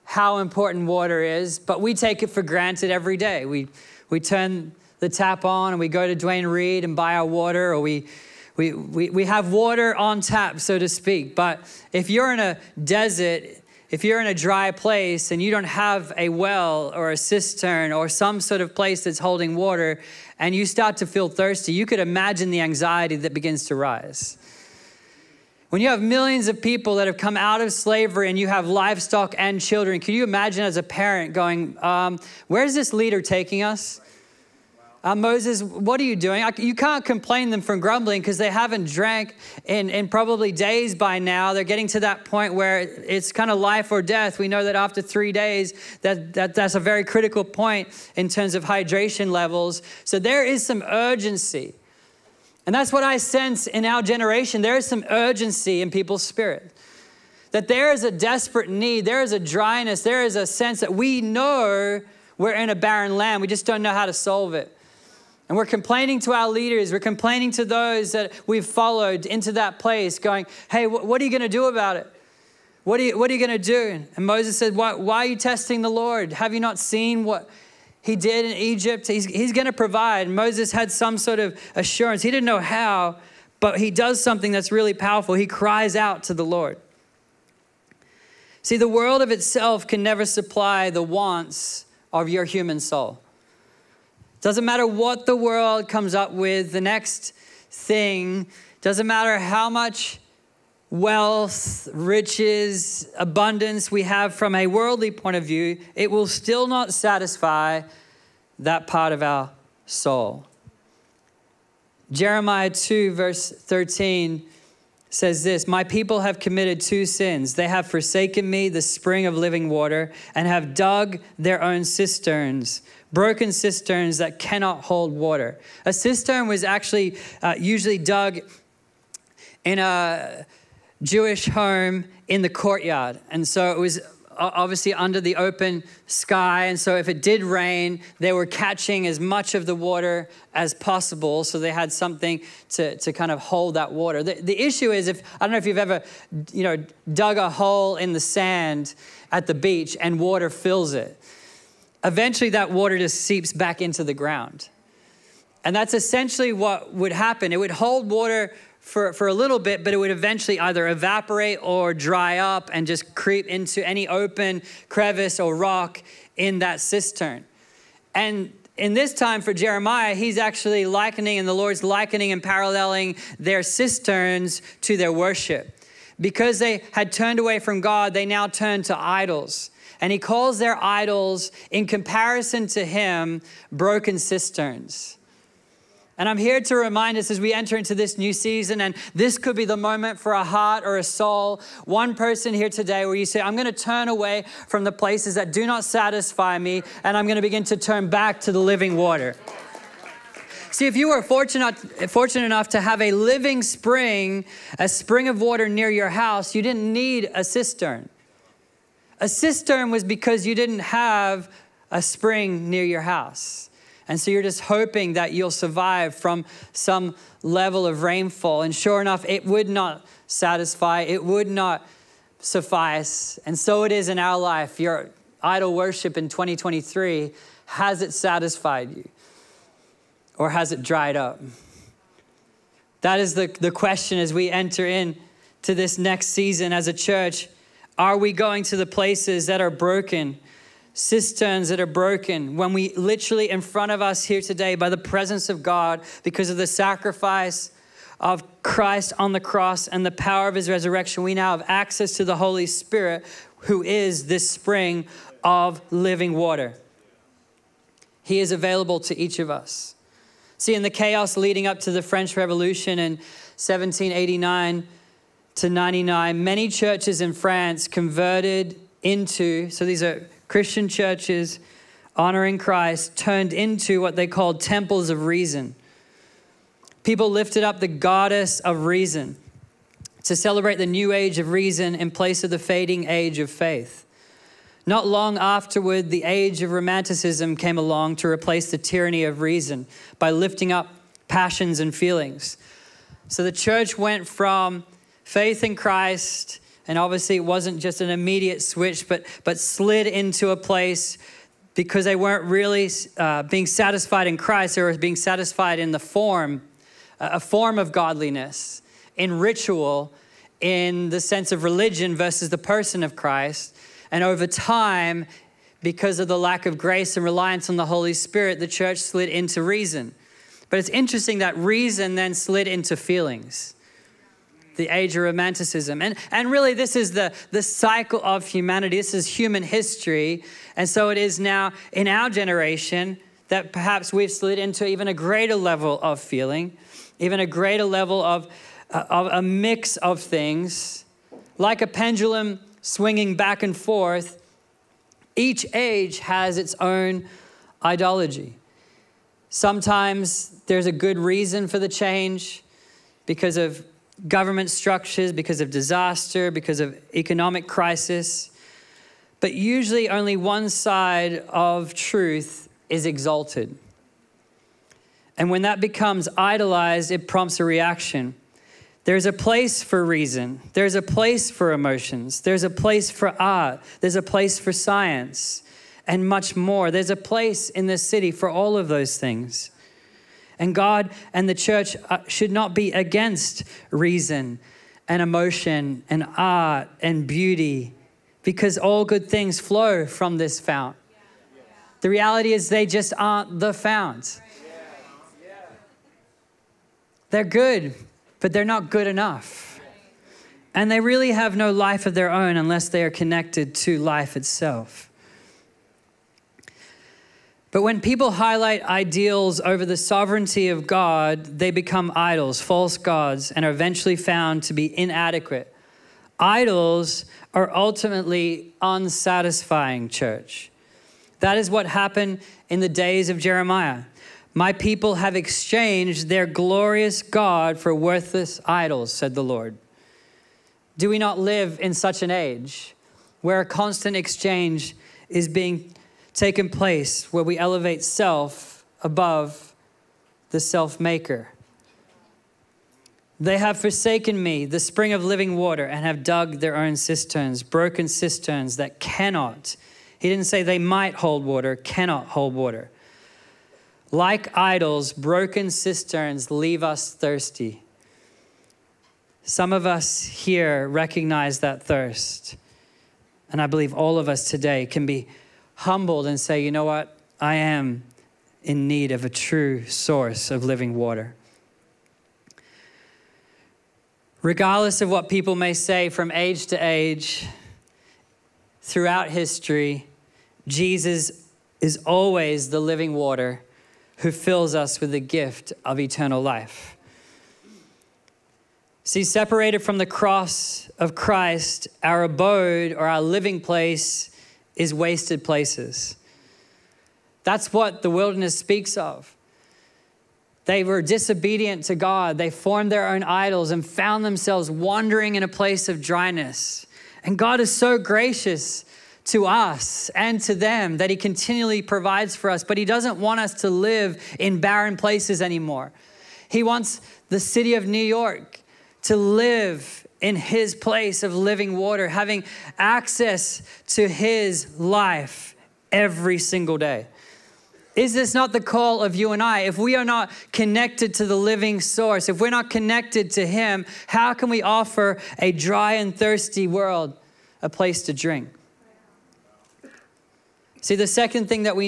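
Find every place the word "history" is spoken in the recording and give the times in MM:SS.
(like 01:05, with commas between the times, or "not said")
05:29, 07:59.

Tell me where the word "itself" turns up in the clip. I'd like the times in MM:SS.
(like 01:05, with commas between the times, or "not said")
01:29, 06:44.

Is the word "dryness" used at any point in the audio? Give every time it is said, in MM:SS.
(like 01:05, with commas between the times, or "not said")
00:59, 08:25.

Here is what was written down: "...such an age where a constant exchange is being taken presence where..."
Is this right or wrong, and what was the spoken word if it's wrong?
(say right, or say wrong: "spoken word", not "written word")
wrong: "place", not "presence".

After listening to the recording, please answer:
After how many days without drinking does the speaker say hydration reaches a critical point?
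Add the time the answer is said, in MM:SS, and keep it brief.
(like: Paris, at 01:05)
3, at 00:45.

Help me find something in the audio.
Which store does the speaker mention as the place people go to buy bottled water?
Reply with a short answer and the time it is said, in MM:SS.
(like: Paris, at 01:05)
Duane Reade, at 00:06.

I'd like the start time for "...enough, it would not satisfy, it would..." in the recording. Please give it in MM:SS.
03:38.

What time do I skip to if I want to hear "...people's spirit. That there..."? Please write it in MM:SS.
00:55.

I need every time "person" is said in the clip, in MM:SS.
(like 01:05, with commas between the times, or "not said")
03:12, 05:12.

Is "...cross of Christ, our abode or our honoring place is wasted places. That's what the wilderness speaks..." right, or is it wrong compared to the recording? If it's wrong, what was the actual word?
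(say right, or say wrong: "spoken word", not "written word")
wrong: "living", not "honoring".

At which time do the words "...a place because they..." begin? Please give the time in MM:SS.
05:00.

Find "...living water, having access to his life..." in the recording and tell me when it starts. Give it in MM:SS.
08:41.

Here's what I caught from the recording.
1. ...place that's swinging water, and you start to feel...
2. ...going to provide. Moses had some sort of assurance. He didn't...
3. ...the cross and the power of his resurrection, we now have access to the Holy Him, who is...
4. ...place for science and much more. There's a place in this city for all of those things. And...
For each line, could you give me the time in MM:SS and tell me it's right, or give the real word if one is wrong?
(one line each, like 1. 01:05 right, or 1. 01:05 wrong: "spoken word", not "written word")
1. 00:18 wrong: "holding", not "swinging"
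2. 01:19 right
3. 04:09 wrong: "Spirit", not "Him"
4. 06:14 right.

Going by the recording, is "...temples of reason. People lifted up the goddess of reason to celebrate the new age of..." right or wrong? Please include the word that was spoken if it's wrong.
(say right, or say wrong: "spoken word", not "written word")
right.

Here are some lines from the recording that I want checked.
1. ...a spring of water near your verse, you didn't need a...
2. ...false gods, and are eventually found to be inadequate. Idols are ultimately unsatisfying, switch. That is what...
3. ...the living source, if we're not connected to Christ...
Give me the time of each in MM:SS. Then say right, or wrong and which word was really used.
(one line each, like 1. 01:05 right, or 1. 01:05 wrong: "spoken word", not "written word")
1. 03:24 wrong: "house", not "verse"
2. 06:52 wrong: "church", not "switch"
3. 08:51 wrong: "Him", not "Christ".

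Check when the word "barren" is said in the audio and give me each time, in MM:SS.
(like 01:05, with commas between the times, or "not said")
01:02, 08:34.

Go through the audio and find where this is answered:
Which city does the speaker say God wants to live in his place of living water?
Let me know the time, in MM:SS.
08:37.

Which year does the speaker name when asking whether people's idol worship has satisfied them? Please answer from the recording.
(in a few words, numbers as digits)
2023.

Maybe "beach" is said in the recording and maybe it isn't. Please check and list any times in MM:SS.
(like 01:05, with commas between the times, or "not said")
02:29.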